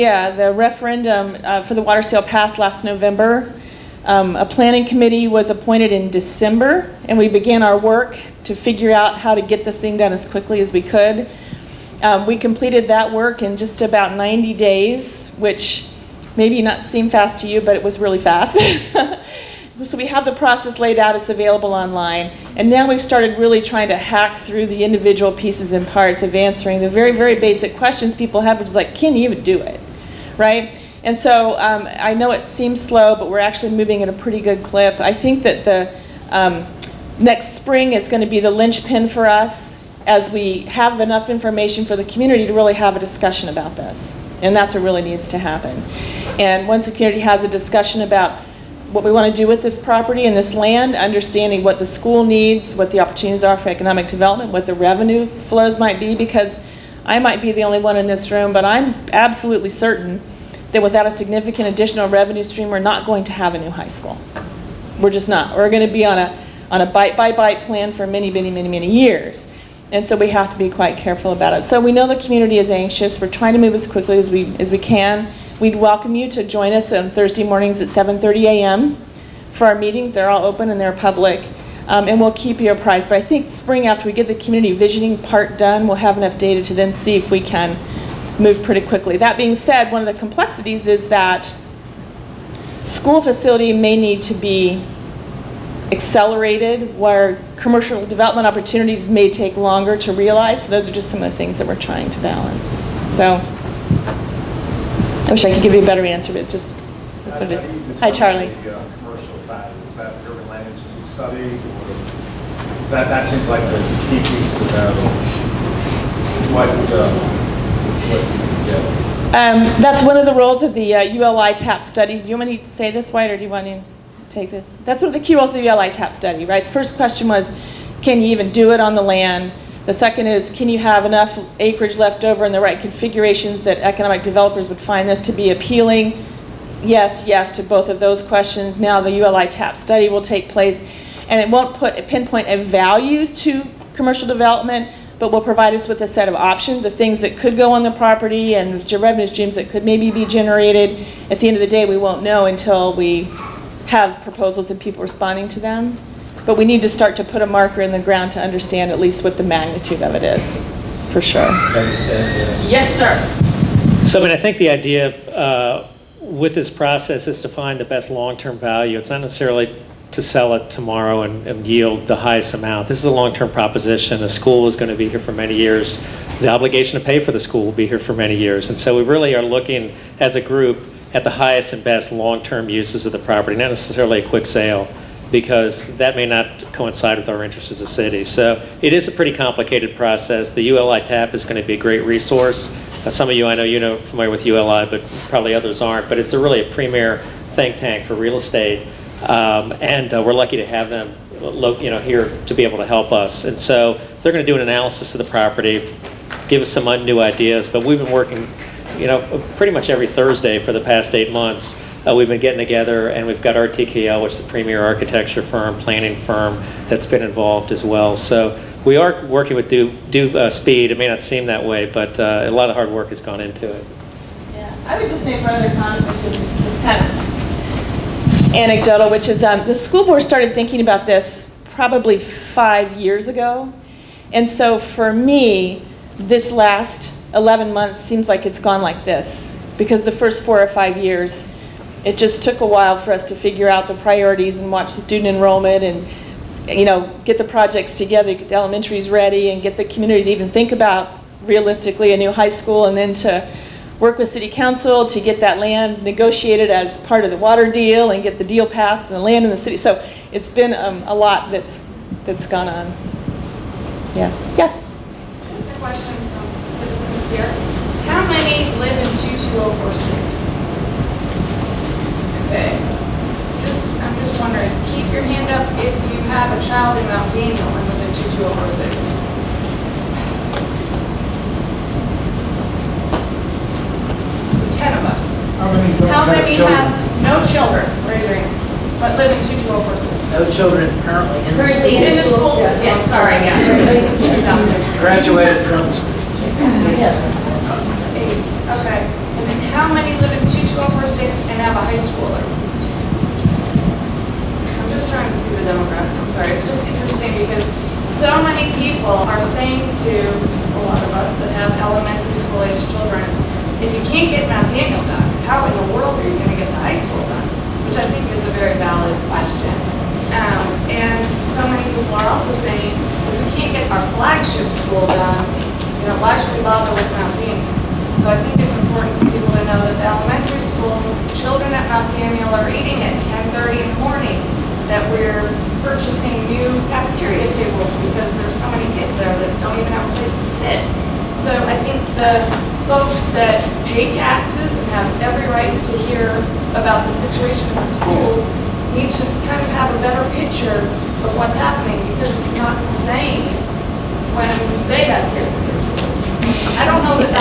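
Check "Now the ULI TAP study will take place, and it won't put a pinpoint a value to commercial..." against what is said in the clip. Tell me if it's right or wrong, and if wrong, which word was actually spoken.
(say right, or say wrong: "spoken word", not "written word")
right.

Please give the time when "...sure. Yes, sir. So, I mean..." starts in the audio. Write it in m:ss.
2:41.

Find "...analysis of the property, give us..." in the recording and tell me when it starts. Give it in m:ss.
3:24.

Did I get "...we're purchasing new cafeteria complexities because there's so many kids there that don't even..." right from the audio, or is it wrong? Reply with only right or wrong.
wrong.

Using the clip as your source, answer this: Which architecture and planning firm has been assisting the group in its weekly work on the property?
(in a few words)
RTKL.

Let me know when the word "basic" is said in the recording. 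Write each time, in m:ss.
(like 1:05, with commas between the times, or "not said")
0:27.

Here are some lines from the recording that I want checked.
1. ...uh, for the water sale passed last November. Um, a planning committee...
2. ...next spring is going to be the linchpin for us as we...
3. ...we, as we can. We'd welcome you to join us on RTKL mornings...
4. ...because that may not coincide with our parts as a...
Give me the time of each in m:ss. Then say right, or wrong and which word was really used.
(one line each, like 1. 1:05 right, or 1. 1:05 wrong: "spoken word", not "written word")
1. 0:01 right
2. 0:37 right
3. 1:14 wrong: "Thursday", not "RTKL"
4. 3:05 wrong: "interests", not "parts".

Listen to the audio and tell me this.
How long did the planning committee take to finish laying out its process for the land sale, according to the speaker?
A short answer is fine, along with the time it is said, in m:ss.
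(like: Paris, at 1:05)
90 days, at 0:14.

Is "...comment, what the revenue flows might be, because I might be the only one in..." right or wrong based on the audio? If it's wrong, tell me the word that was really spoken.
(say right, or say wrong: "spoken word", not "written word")
wrong: "development", not "comment".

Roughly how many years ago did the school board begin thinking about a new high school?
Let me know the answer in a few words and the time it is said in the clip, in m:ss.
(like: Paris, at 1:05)
5 years, at 3:52.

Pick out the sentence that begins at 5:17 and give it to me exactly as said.
Which I think is a very valid question.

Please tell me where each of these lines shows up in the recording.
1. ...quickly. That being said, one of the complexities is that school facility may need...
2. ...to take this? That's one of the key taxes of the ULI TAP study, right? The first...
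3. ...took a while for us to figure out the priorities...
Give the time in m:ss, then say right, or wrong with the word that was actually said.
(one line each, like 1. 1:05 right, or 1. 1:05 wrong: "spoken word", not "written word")
1. 1:28 right
2. 2:03 wrong: "roles", not "taxes"
3. 4:02 right.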